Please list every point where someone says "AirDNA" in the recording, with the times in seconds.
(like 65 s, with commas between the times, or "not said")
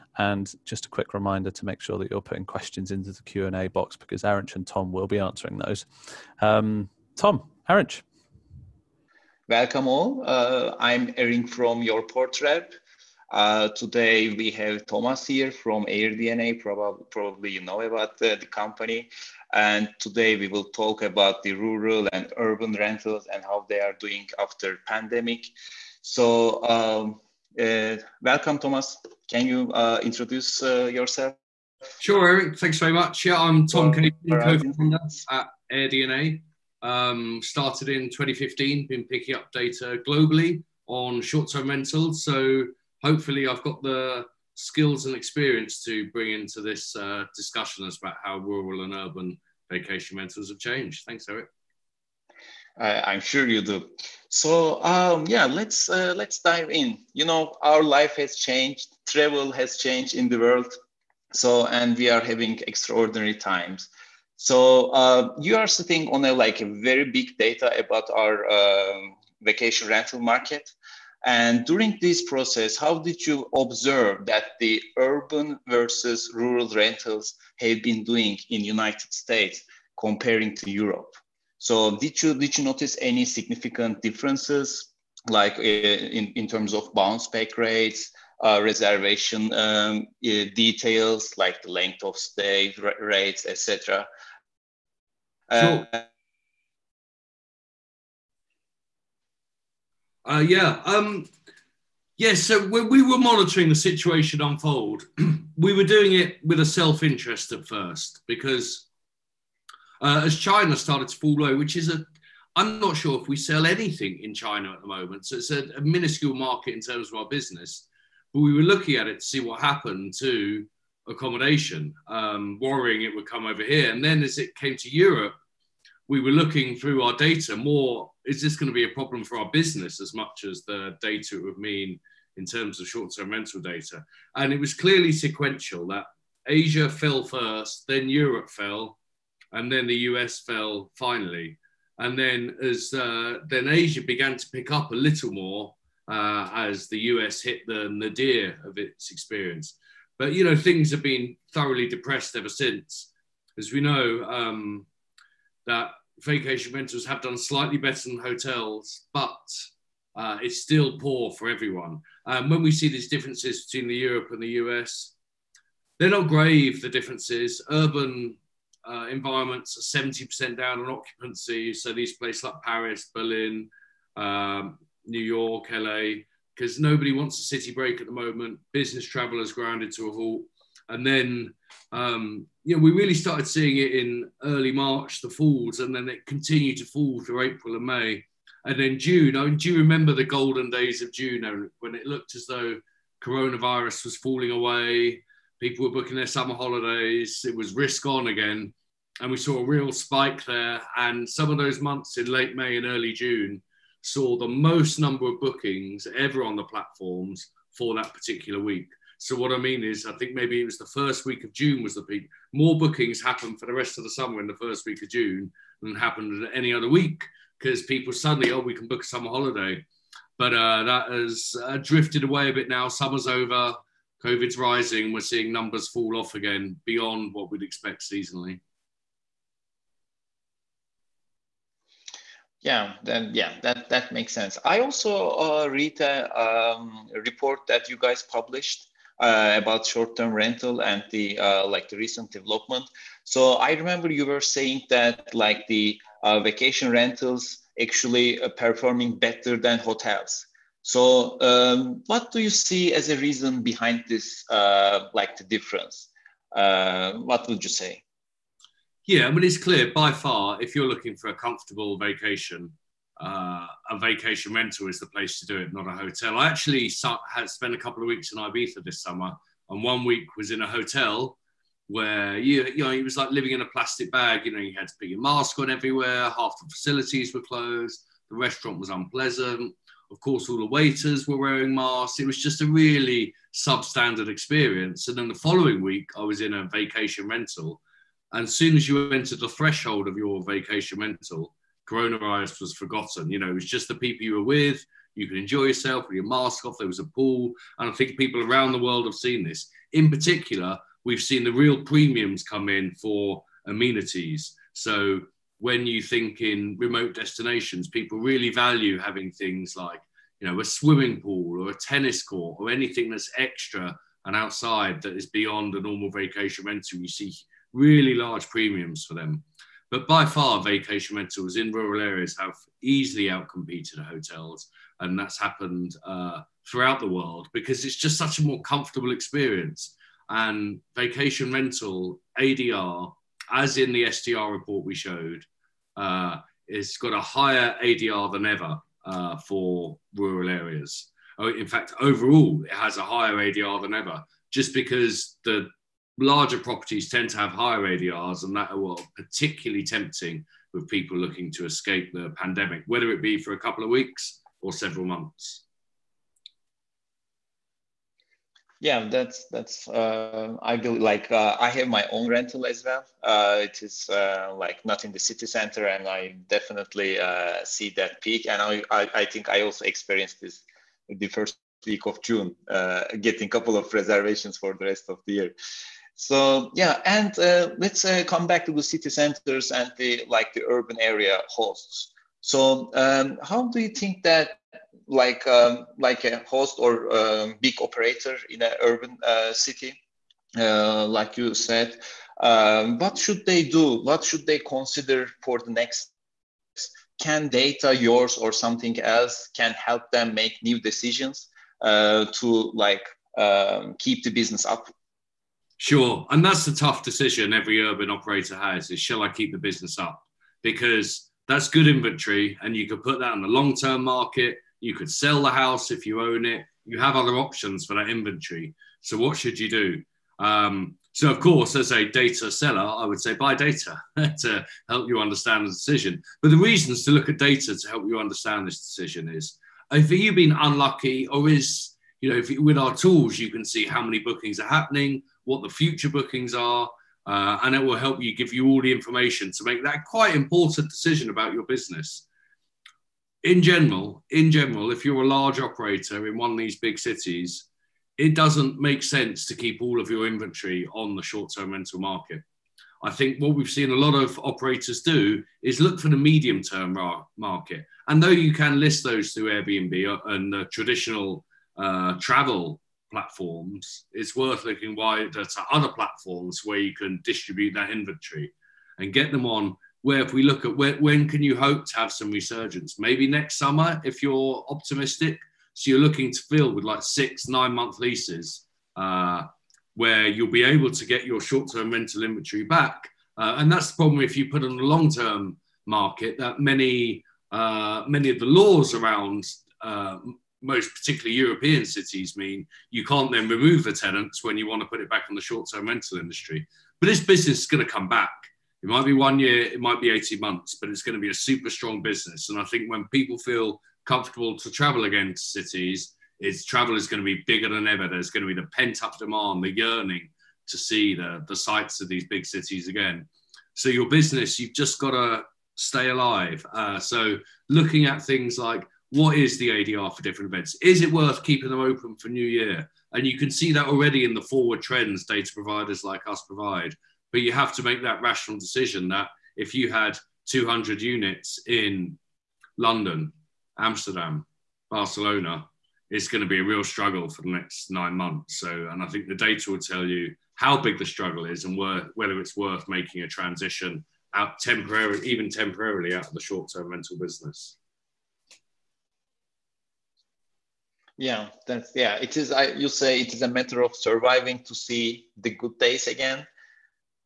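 15 s, 35 s.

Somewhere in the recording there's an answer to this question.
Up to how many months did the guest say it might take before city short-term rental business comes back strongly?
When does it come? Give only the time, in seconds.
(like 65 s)
500 s.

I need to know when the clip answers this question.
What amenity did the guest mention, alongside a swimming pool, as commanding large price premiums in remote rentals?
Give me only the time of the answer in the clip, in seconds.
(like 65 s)
311 s.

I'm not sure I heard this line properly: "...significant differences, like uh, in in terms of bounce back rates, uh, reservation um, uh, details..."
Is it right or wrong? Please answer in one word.
right.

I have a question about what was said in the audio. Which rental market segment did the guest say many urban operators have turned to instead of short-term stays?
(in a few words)
Medium term market.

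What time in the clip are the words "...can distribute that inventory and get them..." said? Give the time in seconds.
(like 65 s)
466 s.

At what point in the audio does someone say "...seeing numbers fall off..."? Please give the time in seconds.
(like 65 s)
225 s.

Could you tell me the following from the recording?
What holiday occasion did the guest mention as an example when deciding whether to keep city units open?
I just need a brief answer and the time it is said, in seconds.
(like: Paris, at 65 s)
New Year, at 522 s.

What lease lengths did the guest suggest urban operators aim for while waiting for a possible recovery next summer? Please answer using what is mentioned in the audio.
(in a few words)
6 to 9 months.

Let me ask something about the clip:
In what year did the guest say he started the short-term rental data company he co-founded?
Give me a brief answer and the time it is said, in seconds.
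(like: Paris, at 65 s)
2015, at 38 s.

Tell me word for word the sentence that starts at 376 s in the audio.
So yeah, and uh, let's uh, come back to the city centers and the like the urban area hosts.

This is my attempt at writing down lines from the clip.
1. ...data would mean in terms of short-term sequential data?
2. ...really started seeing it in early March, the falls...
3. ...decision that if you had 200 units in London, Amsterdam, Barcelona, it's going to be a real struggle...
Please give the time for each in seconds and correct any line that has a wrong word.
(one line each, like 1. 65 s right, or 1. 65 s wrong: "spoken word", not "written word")
1. 131 s wrong: "rental", not "sequential"
2. 182 s right
3. 528 s right.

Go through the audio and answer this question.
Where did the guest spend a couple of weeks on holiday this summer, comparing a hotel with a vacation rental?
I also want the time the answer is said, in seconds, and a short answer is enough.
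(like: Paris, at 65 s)
Ibiza, at 268 s.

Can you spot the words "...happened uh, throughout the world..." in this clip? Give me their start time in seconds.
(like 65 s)
325 s.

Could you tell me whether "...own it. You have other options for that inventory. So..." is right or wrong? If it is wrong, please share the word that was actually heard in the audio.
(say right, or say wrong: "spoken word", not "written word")
right.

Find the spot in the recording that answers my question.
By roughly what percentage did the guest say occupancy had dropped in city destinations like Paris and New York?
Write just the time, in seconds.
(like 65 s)
170 s.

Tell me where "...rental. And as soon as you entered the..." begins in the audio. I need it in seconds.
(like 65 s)
287 s.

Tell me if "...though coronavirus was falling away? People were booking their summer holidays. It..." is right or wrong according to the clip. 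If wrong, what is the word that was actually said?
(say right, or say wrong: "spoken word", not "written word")
right.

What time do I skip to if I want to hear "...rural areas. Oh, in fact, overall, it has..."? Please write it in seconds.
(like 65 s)
340 s.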